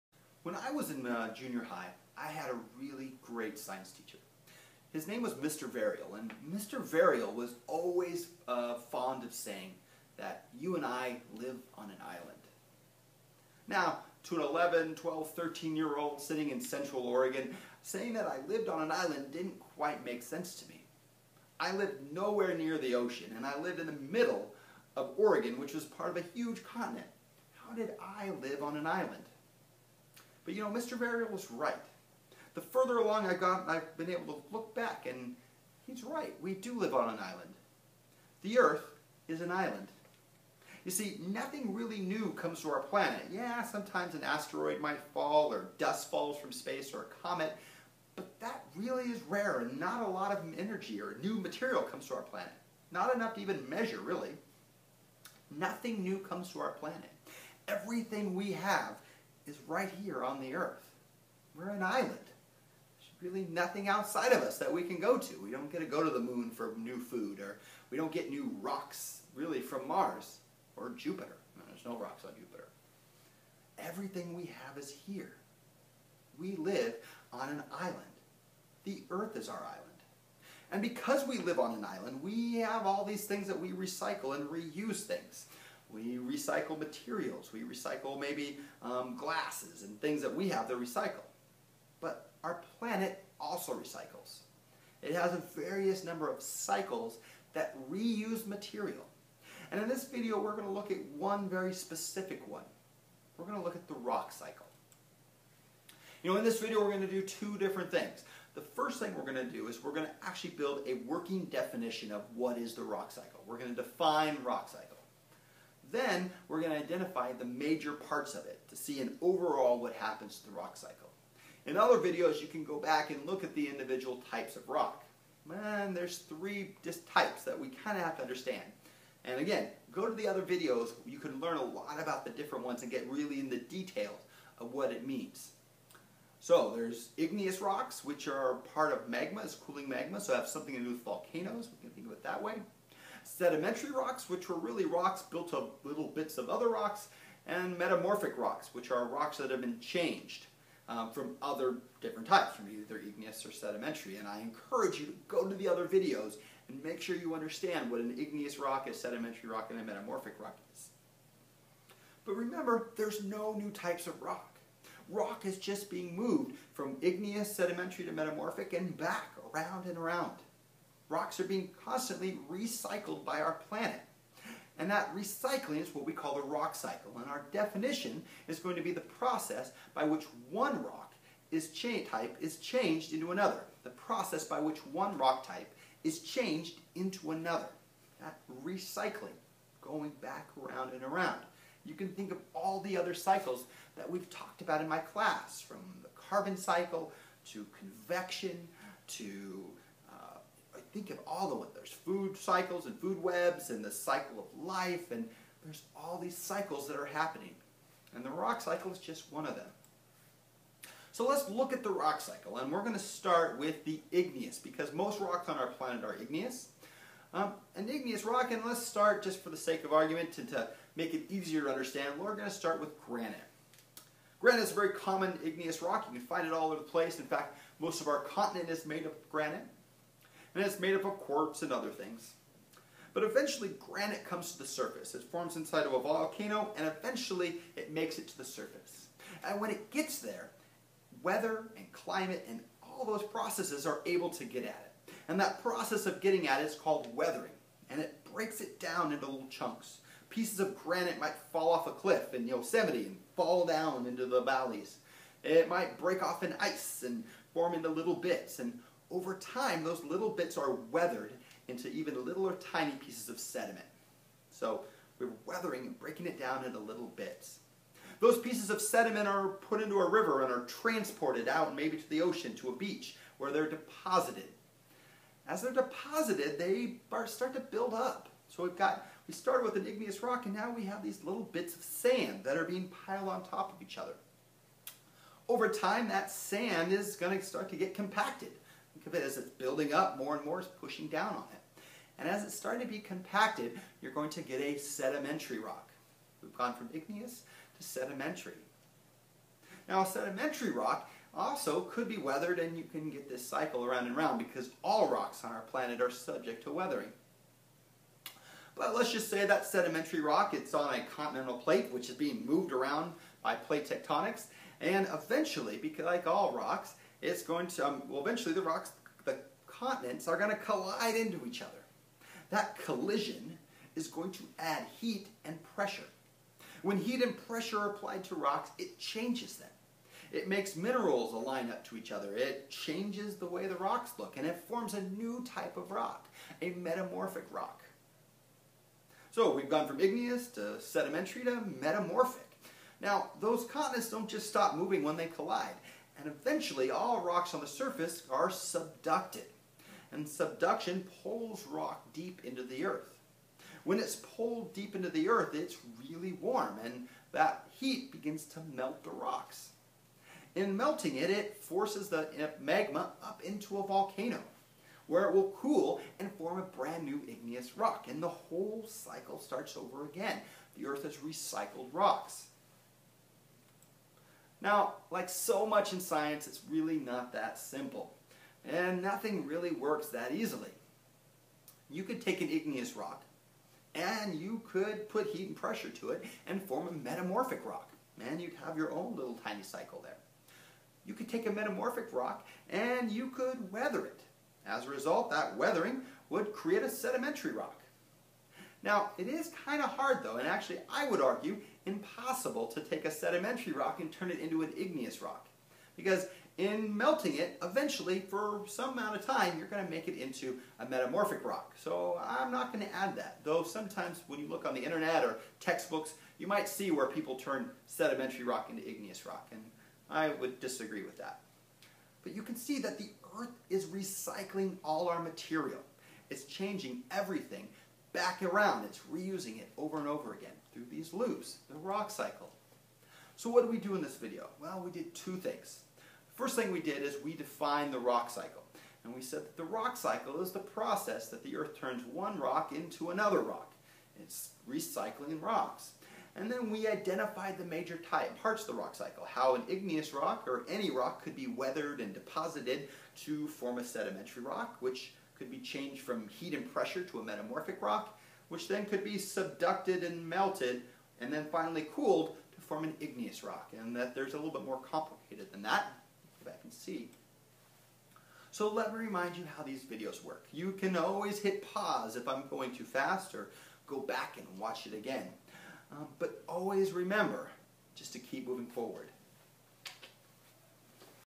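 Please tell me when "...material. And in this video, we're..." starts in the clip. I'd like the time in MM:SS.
01:38.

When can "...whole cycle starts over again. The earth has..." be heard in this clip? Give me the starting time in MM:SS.
06:08.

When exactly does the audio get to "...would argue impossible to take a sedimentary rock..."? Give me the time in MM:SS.
06:41.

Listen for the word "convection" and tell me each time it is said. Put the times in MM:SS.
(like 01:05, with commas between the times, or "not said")
03:17.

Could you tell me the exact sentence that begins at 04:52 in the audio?
And as it's starting to be compacted, you're going to get a sedimentary rock.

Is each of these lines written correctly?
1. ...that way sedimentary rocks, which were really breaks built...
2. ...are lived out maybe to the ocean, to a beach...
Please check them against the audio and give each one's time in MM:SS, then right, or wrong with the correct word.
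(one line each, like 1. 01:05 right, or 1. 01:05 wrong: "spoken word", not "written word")
1. 02:22 wrong: "rocks", not "breaks"
2. 04:30 wrong: "transported", not "lived".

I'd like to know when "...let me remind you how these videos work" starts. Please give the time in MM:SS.
07:48.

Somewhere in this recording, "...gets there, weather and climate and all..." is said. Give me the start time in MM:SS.
03:59.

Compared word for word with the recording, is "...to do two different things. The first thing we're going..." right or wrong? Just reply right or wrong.
right.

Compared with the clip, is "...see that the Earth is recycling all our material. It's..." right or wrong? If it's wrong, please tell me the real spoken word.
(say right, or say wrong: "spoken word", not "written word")
right.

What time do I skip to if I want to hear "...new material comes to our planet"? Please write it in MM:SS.
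00:51.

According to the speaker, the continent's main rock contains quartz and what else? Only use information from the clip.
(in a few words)
other things.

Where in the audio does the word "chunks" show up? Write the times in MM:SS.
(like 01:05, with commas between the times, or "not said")
04:09.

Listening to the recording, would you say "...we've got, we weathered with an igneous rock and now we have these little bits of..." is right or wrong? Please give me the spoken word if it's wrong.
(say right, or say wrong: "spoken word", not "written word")
wrong: "started", not "weathered".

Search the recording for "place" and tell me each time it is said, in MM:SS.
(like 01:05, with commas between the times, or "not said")
03:46.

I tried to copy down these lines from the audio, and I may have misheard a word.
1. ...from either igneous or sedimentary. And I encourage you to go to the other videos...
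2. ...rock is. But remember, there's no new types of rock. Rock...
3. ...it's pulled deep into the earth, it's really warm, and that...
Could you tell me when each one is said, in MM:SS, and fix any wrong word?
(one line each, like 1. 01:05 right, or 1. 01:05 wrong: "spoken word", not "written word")
1. 02:32 right
2. 02:40 right
3. 05:53 right.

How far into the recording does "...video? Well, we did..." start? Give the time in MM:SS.
07:14.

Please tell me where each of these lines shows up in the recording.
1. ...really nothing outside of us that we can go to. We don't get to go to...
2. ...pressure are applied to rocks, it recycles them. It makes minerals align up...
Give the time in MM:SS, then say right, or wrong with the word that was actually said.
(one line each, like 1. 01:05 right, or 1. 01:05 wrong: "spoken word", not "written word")
1. 01:03 right
2. 05:27 wrong: "changes", not "recycles".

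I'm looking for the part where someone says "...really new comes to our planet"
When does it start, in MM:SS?
00:41.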